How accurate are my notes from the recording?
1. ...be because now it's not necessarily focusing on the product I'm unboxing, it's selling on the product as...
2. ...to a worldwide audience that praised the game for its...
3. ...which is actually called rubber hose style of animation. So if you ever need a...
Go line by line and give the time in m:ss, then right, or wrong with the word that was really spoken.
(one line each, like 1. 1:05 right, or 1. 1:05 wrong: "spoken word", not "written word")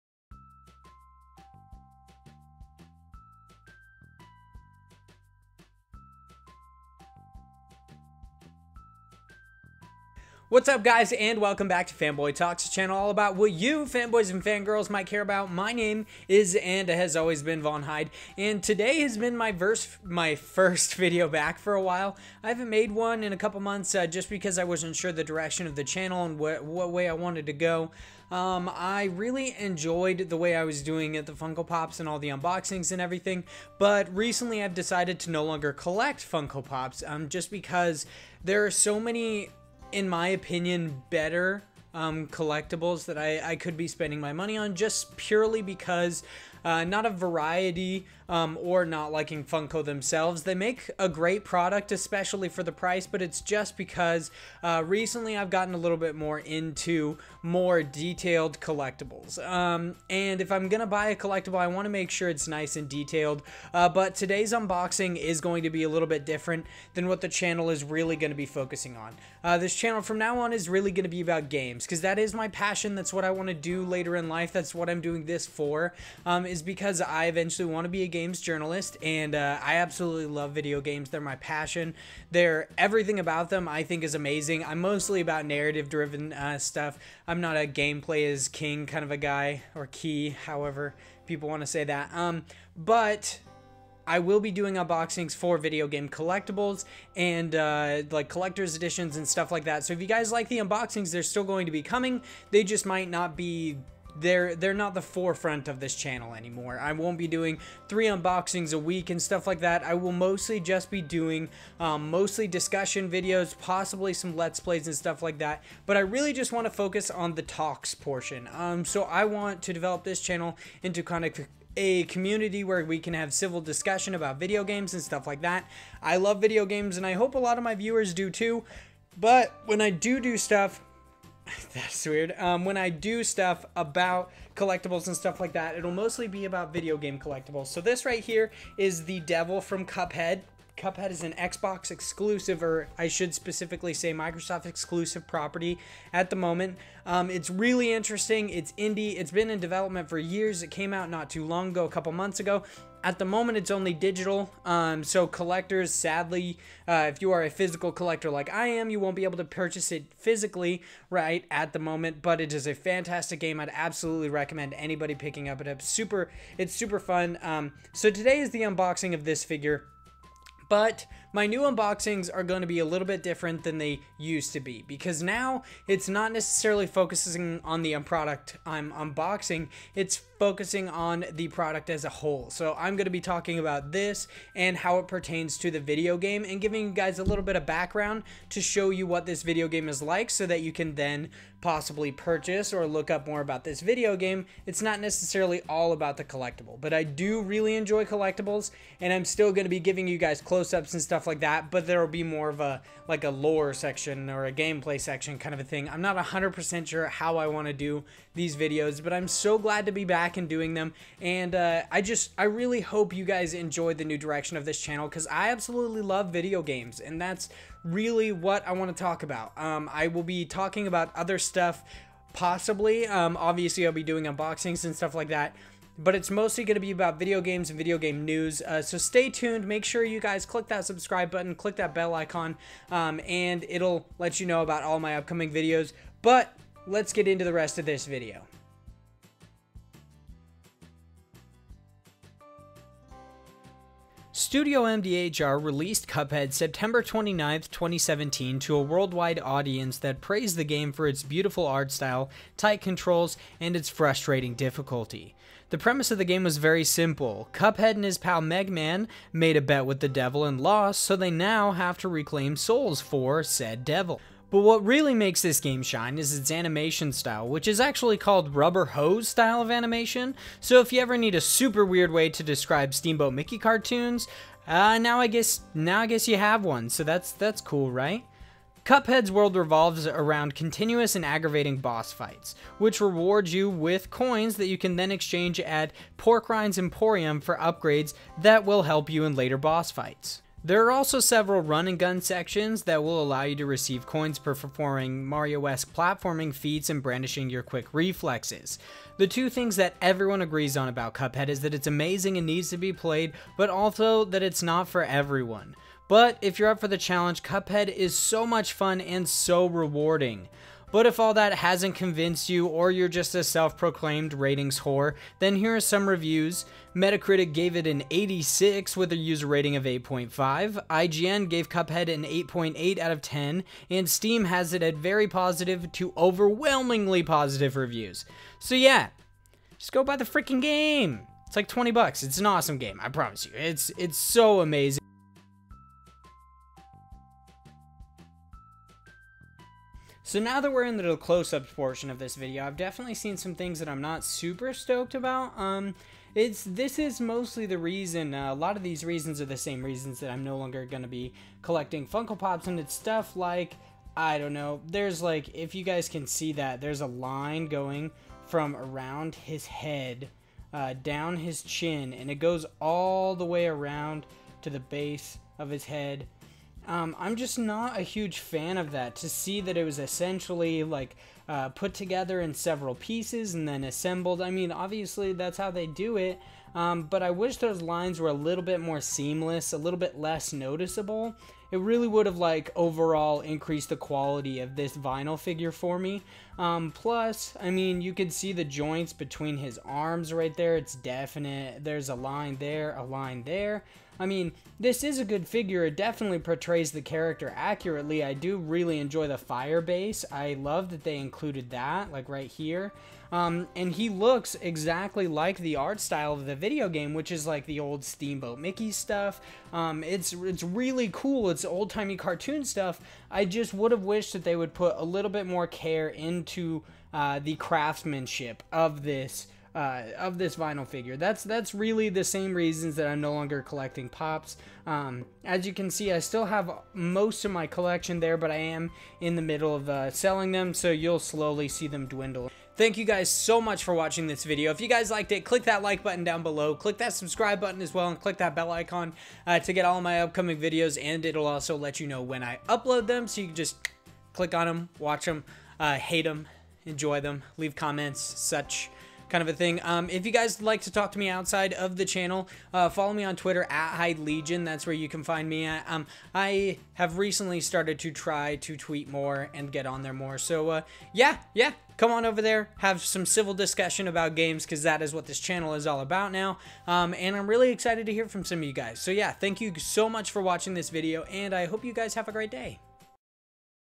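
1. 2:54 wrong: "focusing", not "selling"
2. 4:08 right
3. 4:27 right.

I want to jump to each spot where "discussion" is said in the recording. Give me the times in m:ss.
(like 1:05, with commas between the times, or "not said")
1:52, 2:03, 7:43.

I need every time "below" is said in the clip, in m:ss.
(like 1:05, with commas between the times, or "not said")
7:16.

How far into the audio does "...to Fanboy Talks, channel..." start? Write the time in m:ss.
0:11.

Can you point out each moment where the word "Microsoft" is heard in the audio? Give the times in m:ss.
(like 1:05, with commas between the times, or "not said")
2:24.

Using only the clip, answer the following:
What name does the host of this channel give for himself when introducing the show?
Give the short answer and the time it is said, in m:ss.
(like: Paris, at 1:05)
Von Hyde, at 0:17.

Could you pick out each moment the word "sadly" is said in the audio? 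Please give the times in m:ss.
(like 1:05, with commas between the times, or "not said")
2:35.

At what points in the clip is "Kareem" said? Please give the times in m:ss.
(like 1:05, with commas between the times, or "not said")
not said.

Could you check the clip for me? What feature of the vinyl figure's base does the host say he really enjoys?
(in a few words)
fire base.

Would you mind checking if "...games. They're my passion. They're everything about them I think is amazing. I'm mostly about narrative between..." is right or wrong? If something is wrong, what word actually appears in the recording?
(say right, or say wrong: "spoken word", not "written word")
wrong: "driven", not "between".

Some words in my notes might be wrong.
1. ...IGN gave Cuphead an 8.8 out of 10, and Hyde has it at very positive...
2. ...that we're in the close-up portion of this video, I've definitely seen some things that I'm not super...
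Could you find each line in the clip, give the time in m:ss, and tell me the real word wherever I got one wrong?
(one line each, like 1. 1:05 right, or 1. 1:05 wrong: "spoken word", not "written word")
1. 5:20 wrong: "Steam", not "Hyde"
2. 5:40 right.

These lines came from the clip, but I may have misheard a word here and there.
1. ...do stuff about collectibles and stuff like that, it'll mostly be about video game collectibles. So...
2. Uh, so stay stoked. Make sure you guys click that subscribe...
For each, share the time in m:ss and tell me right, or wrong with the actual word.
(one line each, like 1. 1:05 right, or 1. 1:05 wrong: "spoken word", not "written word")
1. 2:12 right
2. 3:48 wrong: "tuned", not "stoked".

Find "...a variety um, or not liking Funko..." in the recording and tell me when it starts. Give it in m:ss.
0:47.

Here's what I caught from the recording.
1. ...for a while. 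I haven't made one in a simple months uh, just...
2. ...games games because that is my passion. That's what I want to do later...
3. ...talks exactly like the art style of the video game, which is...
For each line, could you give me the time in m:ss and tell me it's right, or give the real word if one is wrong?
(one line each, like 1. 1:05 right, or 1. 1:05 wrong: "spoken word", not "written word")
1. 0:21 wrong: "couple", not "simple"
2. 1:11 right
3. 6:44 wrong: "looks", not "talks".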